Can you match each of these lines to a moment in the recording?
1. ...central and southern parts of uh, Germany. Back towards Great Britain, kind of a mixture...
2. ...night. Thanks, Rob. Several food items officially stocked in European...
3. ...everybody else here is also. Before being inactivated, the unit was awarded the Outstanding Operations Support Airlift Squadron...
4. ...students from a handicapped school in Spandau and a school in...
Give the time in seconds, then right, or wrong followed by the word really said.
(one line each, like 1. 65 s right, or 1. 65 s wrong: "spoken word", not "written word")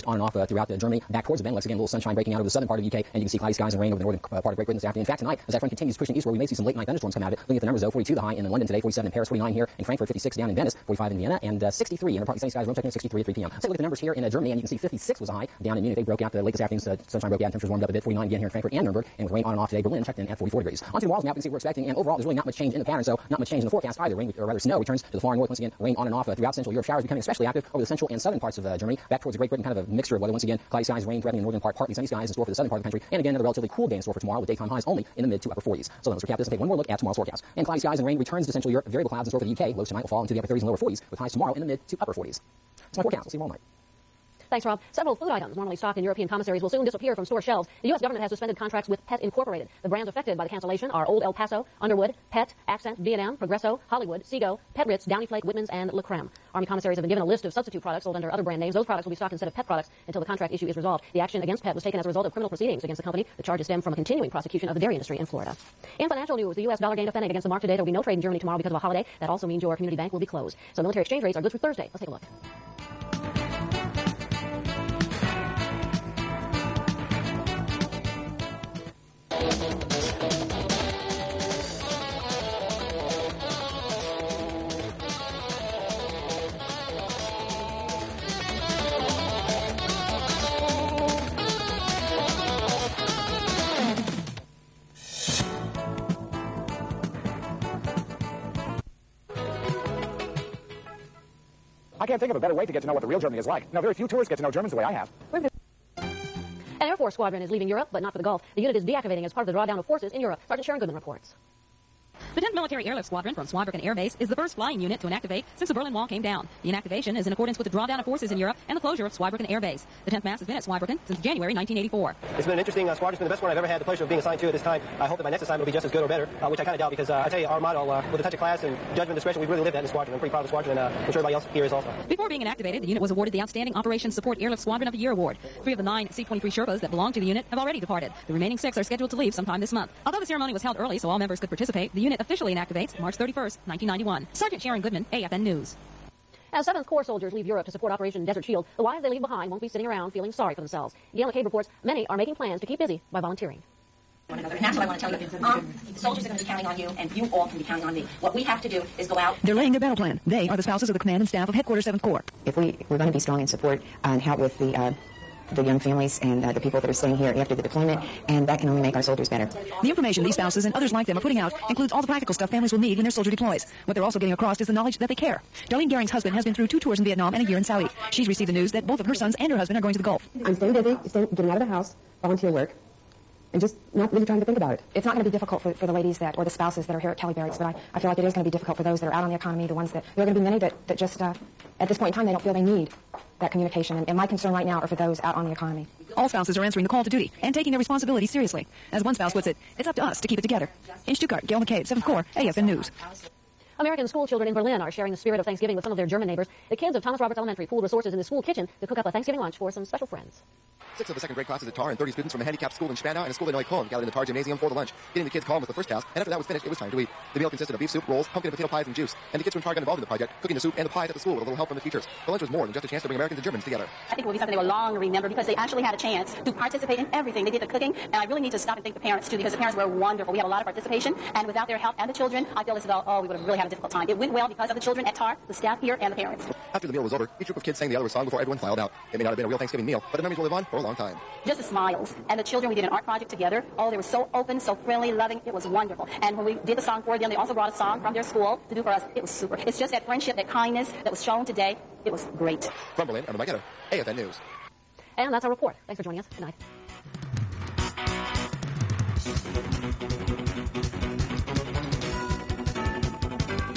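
1. 27 s right
2. 43 s wrong: "normally", not "officially"
3. 131 s right
4. 212 s right.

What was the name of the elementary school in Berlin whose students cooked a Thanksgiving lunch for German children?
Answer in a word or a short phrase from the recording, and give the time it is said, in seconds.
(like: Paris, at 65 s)
Thomas Roberts Elementary, at 207 s.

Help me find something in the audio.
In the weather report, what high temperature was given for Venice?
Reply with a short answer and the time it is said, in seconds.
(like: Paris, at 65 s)
56, at 10 s.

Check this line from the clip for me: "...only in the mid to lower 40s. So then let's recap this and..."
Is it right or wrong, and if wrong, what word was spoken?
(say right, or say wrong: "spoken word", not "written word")
wrong: "upper", not "lower".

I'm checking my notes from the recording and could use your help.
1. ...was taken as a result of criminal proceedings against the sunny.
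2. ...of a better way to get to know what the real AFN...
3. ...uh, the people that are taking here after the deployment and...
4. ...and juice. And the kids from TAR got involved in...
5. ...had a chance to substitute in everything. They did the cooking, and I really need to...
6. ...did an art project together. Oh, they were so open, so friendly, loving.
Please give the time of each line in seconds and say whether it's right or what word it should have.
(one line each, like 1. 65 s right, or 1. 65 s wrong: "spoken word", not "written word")
1. 61 s wrong: "company", not "sunny"
2. 102 s wrong: "Germany", not "AFN"
3. 166 s wrong: "staying", not "taking"
4. 218 s right
5. 225 s wrong: "participate", not "substitute"
6. 242 s right.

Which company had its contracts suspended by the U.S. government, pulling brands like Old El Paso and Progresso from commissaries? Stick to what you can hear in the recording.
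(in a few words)
Pet Incorporated.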